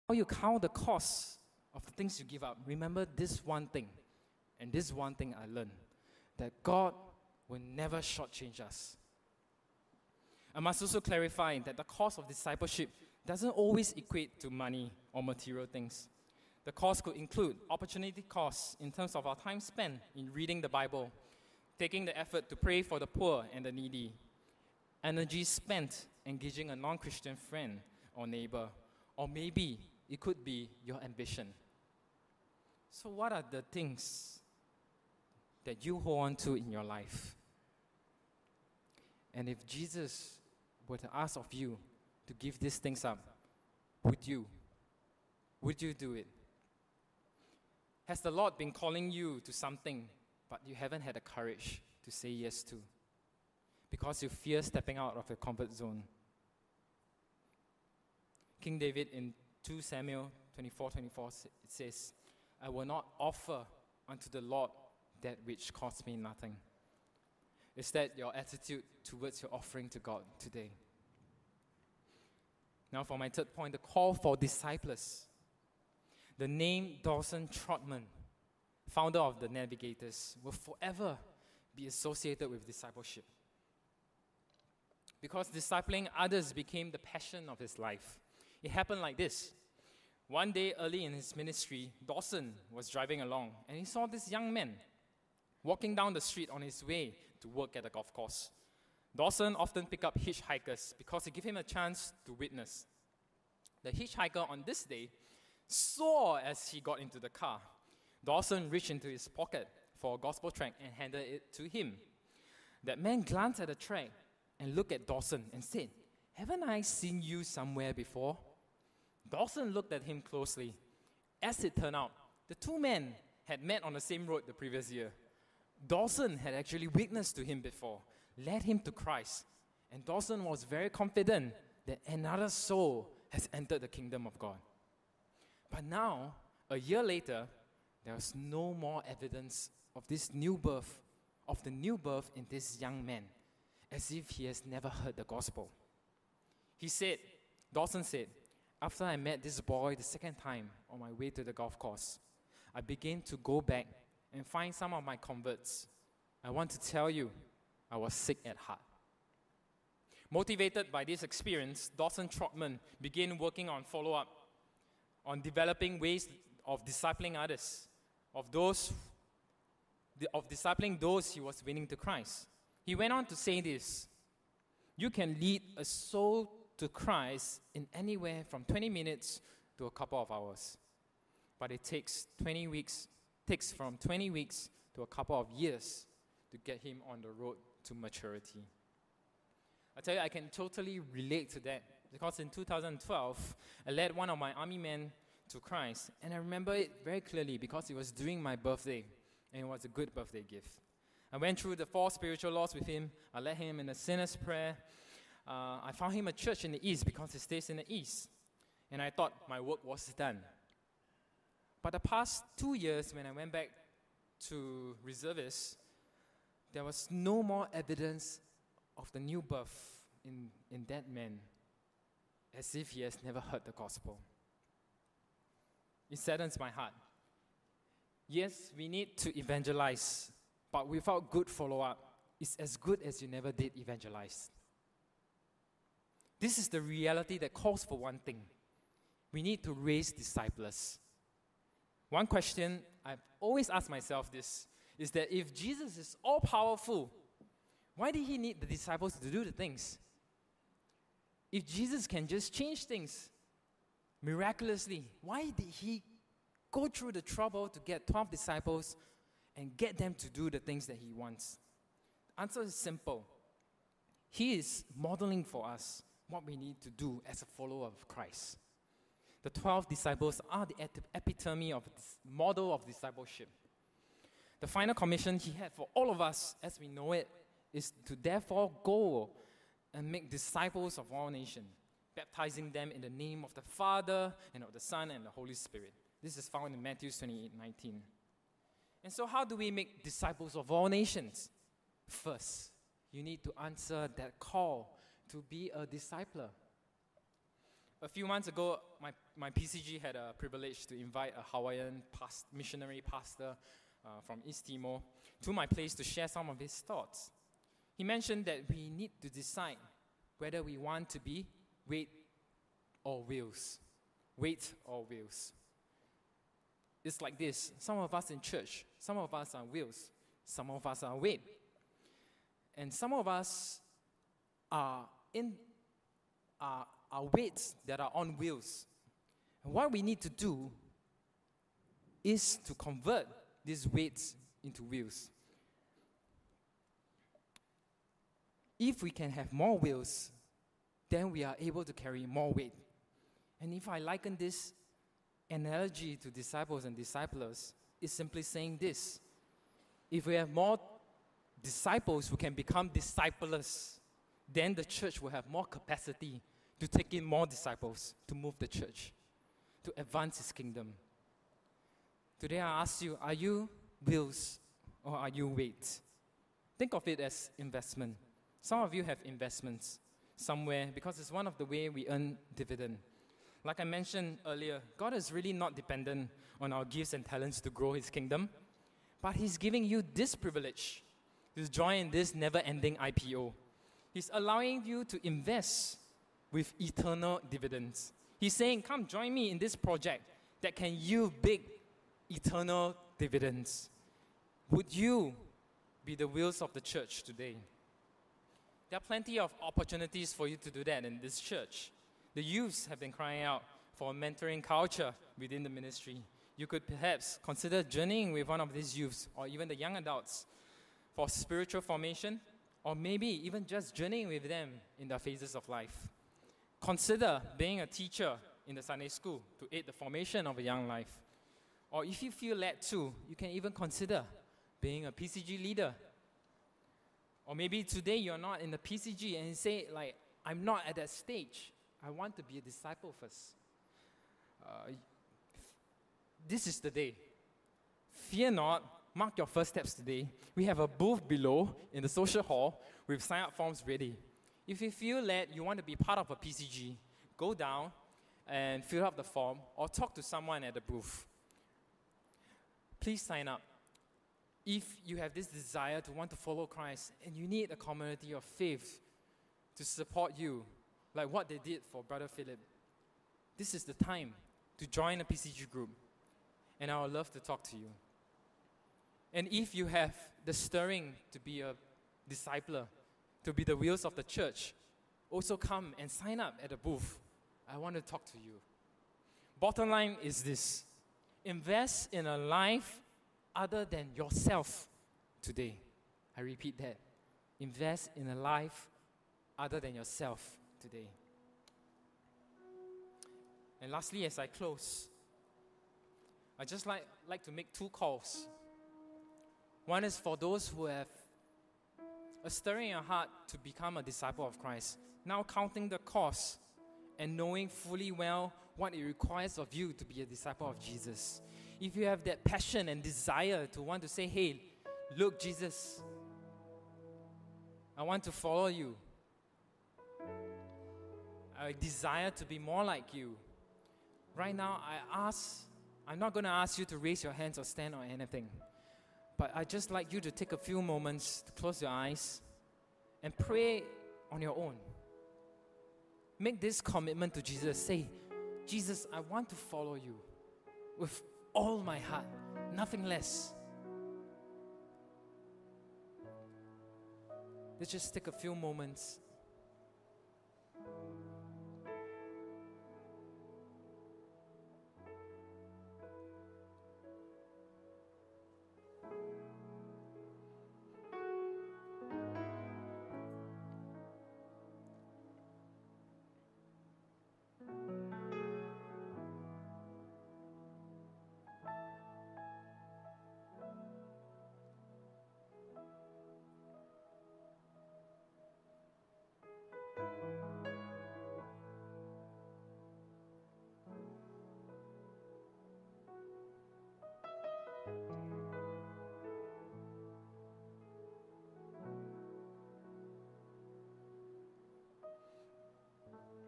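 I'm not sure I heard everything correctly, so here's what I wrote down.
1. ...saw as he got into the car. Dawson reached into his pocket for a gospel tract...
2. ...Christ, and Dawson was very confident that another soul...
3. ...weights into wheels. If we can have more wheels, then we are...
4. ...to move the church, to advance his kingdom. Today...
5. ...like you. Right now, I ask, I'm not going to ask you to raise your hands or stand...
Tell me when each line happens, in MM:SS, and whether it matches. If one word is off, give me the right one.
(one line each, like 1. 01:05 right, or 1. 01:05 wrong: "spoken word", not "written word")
1. 01:45 right
2. 02:08 right
3. 05:33 right
4. 05:58 right
5. 08:42 right.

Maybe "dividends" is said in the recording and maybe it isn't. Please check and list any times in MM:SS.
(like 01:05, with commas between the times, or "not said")
06:12, 06:27, 06:33.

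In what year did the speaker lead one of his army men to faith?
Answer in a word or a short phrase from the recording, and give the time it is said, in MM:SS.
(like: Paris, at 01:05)
2012, at 03:12.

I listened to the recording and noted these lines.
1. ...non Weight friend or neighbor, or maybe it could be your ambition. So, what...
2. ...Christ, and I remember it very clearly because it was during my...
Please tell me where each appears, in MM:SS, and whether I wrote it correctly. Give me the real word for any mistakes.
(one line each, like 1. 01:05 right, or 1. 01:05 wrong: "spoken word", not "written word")
1. 00:26 wrong: "Christian", not "Weight"
2. 03:15 right.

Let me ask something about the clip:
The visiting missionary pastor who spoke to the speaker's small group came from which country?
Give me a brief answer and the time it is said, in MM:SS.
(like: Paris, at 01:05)
East Timor, at 05:04.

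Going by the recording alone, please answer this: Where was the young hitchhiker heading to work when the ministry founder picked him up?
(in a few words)
A golf course.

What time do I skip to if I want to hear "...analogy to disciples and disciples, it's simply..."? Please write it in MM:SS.
05:45.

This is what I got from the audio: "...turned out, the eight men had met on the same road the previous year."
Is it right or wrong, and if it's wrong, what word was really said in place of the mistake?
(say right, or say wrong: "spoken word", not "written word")
wrong: "two", not "eight".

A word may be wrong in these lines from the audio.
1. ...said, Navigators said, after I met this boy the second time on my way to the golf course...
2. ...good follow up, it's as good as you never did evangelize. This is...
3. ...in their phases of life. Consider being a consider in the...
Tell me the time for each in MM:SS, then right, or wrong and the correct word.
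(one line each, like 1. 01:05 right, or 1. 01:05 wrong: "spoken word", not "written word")
1. 02:26 wrong: "Dawson", not "Navigators"
2. 03:51 right
3. 06:54 wrong: "teacher", not "consider".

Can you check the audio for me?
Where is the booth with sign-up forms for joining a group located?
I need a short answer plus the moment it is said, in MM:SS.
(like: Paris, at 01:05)
The social hall, at 07:22.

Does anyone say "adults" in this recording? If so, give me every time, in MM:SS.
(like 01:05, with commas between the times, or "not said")
06:49.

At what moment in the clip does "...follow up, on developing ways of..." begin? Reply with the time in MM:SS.
02:43.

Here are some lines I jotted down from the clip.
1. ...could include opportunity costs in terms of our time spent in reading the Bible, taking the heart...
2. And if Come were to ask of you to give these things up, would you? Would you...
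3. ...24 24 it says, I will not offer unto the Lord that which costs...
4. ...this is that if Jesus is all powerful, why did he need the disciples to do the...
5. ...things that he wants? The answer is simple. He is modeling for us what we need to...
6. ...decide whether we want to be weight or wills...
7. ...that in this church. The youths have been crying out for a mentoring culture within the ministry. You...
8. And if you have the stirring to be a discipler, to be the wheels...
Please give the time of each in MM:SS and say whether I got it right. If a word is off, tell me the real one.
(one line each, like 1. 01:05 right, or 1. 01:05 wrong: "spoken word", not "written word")
1. 00:17 wrong: "effort", not "heart"
2. 00:39 wrong: "Jesus", not "Come"
3. 01:00 right
4. 04:04 right
5. 04:20 right
6. 05:09 wrong: "wheels", not "wills"
7. 06:40 right
8. 07:49 right.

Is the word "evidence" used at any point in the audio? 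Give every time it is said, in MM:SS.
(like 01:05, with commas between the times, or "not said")
02:19, 03:37.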